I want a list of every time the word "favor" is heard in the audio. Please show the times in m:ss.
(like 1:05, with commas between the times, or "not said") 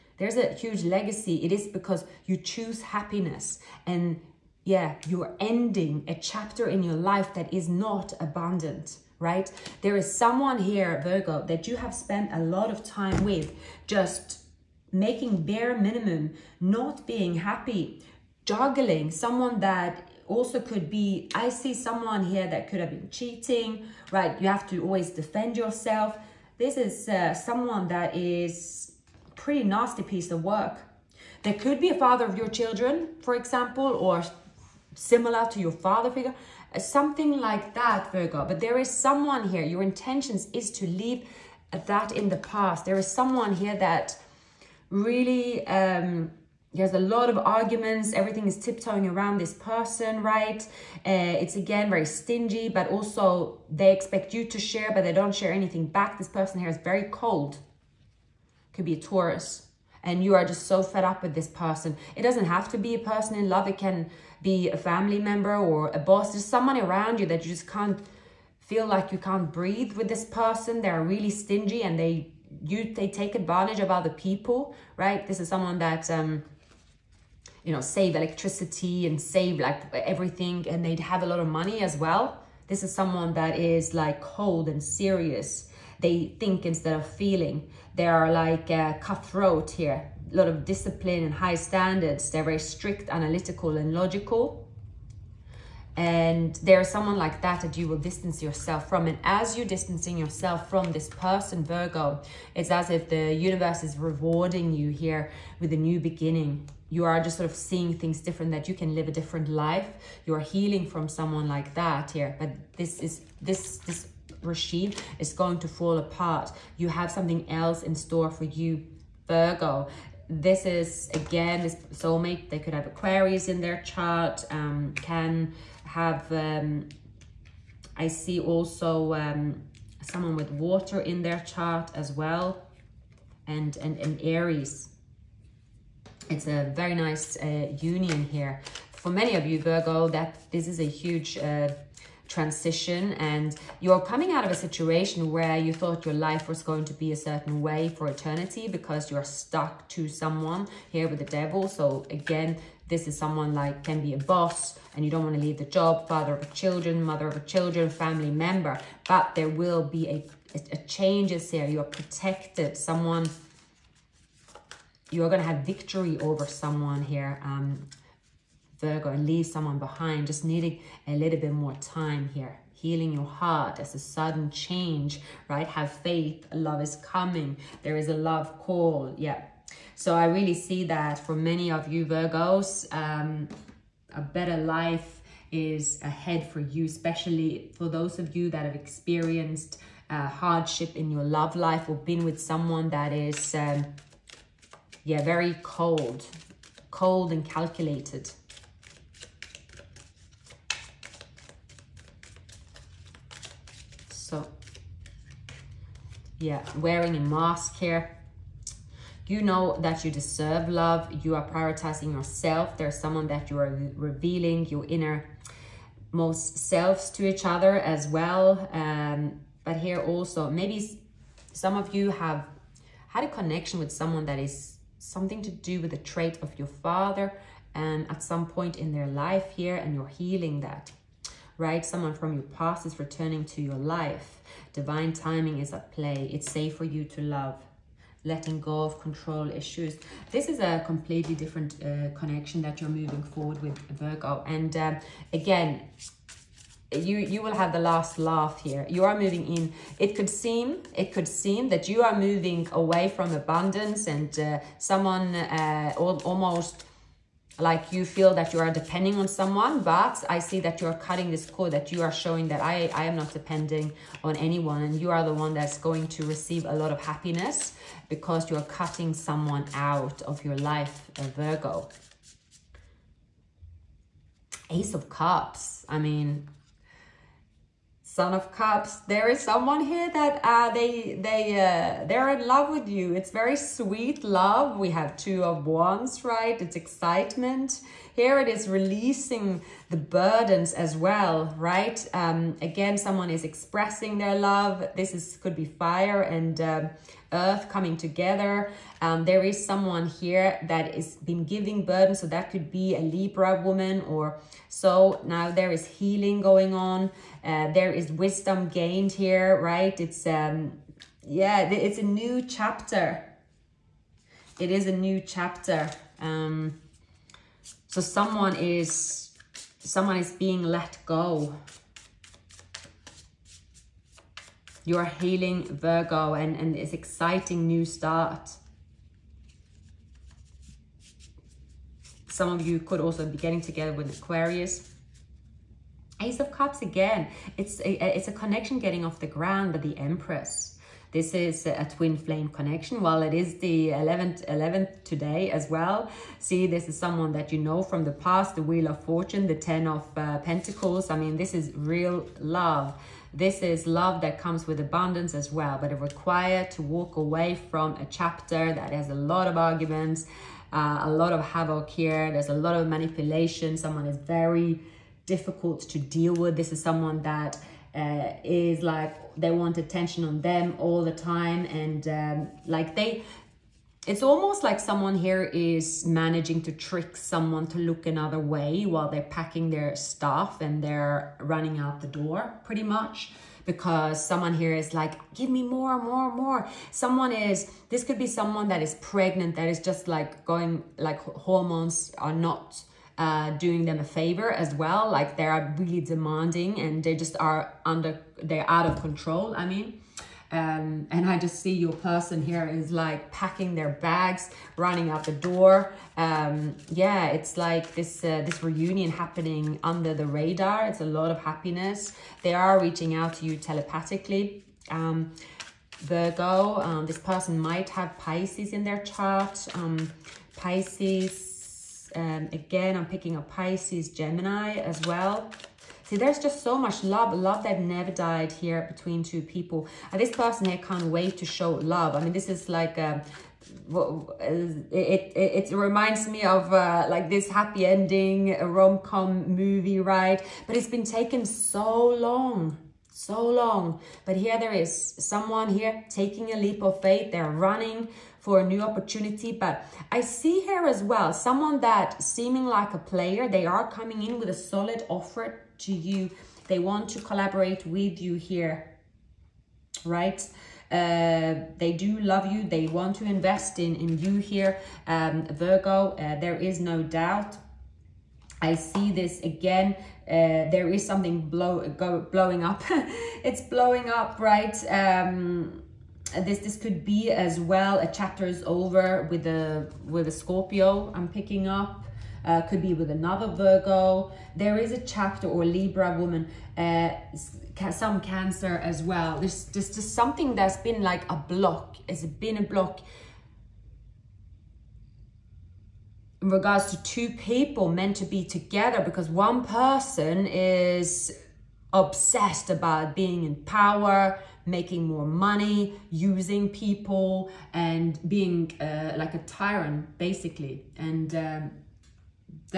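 6:34.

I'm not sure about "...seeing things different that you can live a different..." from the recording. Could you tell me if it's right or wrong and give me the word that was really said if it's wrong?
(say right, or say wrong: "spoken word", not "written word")
right.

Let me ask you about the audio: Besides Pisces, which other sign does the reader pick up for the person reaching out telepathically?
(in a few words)
Gemini.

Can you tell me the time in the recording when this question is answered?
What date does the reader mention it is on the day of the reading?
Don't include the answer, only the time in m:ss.
5:44.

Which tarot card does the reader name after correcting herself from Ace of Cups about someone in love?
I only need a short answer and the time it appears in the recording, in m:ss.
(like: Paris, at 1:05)
Son of Cups, at 4:38.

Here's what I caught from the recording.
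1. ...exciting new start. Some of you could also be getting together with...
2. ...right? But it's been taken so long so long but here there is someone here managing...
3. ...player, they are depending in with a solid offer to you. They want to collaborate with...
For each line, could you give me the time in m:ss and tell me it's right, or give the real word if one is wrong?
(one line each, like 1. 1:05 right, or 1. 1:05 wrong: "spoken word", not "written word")
1. 5:26 right
2. 7:20 wrong: "taking", not "managing"
3. 7:32 wrong: "coming", not "depending".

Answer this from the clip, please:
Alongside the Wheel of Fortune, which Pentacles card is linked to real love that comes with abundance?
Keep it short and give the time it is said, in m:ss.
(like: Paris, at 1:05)
10 of Pentacles, at 5:49.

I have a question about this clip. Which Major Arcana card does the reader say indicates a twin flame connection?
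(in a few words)
The Empress.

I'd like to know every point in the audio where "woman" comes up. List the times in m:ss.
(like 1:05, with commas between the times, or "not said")
5:03, 8:06.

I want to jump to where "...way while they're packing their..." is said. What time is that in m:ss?
6:18.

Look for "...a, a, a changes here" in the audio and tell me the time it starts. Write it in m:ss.
2:40.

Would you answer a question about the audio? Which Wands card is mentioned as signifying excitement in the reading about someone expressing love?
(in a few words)
Two of Wands.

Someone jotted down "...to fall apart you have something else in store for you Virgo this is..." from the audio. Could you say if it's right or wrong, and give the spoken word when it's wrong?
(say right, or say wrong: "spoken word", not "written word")
right.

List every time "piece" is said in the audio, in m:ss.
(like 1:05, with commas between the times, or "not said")
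0:30.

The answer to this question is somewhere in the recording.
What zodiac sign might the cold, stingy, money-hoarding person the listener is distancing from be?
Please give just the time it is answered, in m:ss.
0:58.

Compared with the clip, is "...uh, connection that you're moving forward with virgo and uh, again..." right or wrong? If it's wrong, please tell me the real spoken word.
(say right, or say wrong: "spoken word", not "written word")
right.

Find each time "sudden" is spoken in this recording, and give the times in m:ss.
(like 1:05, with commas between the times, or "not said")
2:53.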